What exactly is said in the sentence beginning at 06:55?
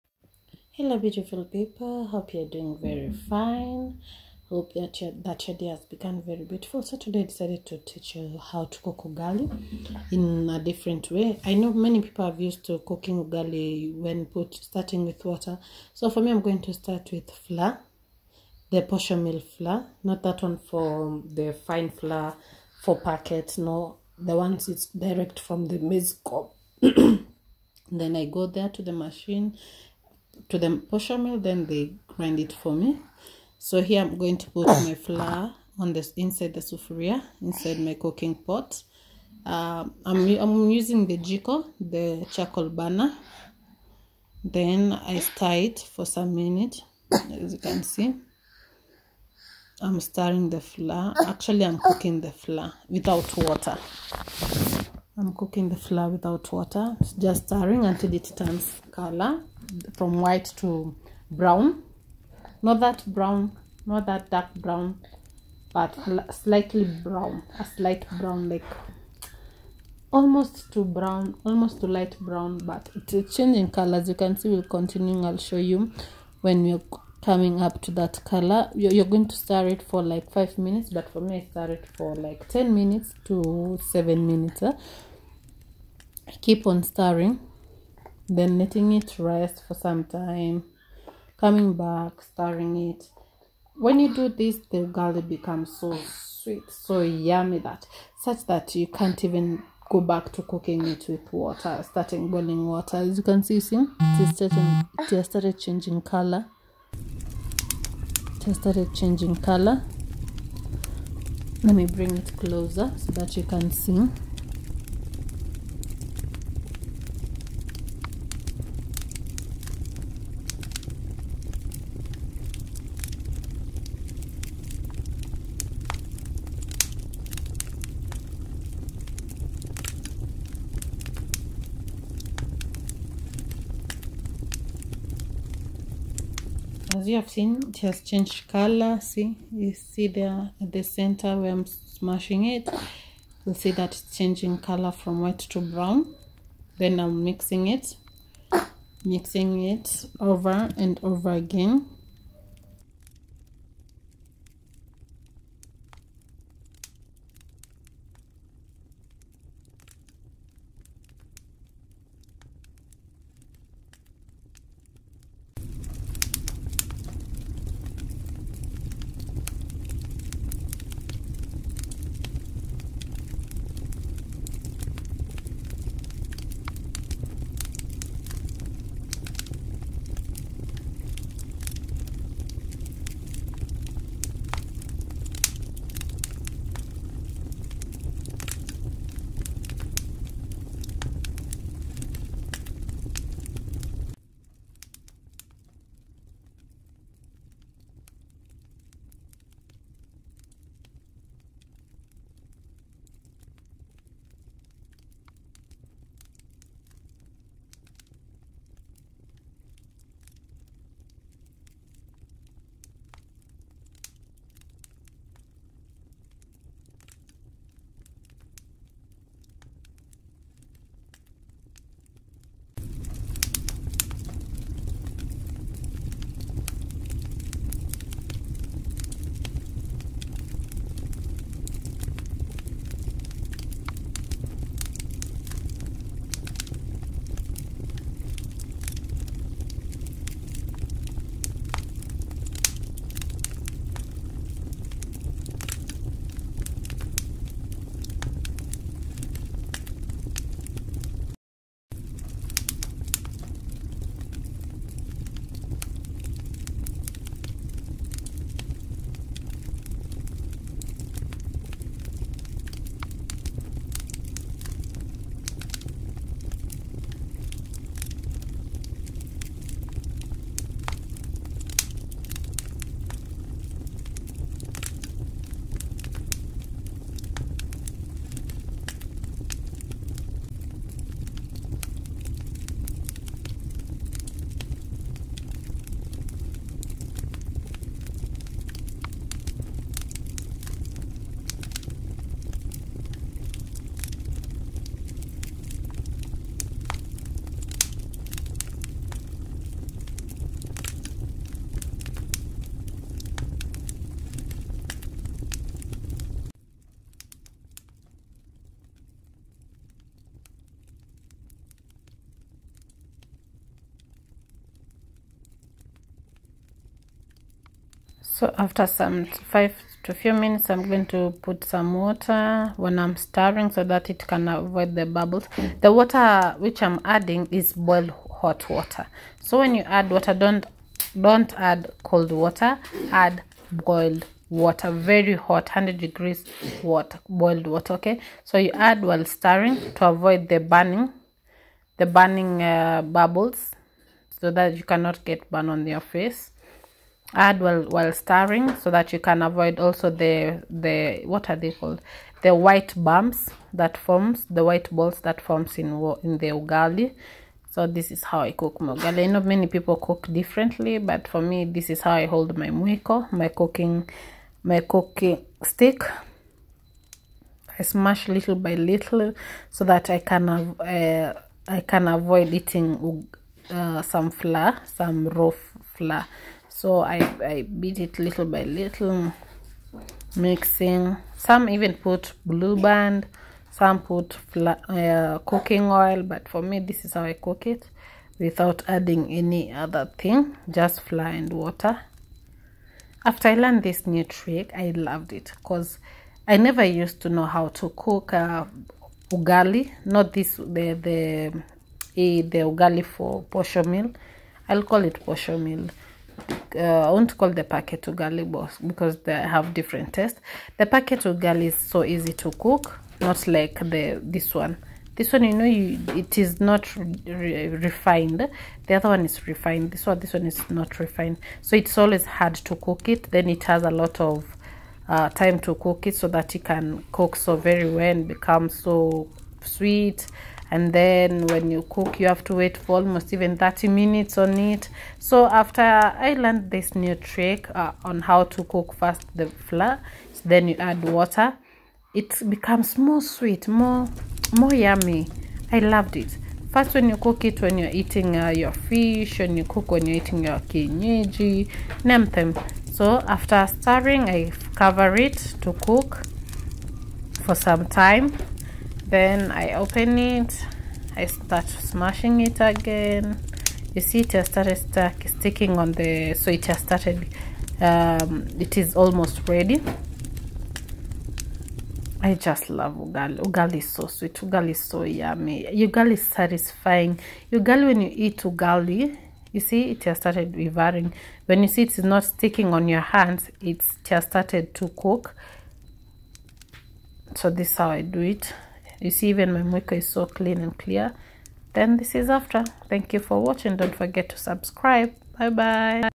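This one, you know, you, it is not re refined.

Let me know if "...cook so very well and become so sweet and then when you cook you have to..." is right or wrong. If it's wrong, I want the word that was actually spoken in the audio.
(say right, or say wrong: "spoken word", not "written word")
right.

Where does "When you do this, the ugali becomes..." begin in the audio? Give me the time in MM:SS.
01:33.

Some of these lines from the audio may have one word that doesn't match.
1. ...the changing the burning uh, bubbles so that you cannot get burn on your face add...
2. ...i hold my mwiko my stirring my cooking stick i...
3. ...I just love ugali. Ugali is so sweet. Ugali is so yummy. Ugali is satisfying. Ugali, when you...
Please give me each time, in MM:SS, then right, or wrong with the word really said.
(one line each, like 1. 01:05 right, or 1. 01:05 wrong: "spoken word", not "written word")
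1. 05:40 wrong: "burning", not "changing"
2. 06:02 wrong: "cooking", not "stirring"
3. 07:52 right.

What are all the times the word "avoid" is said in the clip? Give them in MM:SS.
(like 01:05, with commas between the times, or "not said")
05:24, 05:40, 05:49, 06:12.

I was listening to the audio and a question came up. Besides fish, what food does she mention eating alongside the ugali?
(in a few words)
Kienyeji.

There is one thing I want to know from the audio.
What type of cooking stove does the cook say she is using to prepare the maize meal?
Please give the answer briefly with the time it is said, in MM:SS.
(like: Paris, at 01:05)
Charcoal burner, at 00:41.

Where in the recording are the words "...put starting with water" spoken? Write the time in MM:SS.
00:14.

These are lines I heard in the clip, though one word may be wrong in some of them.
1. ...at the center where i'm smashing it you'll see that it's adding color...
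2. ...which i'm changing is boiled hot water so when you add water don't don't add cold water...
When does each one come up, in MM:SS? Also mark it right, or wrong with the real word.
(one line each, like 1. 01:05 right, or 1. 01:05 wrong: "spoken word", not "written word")
1. 02:20 wrong: "changing", not "adding"
2. 05:26 wrong: "adding", not "changing".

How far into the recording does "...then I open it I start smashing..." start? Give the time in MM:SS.
07:39.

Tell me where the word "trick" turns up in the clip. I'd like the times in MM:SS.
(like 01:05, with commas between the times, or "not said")
06:34, 07:17.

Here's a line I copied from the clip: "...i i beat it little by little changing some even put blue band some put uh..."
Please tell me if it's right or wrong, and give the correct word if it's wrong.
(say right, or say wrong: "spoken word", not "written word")
wrong: "mixing", not "changing".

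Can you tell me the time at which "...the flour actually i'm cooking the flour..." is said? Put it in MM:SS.
00:50.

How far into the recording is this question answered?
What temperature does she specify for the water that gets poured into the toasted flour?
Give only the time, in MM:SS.
05:35.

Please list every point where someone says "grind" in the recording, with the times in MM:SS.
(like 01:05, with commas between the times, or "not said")
00:32.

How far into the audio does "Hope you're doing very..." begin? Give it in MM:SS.
00:02.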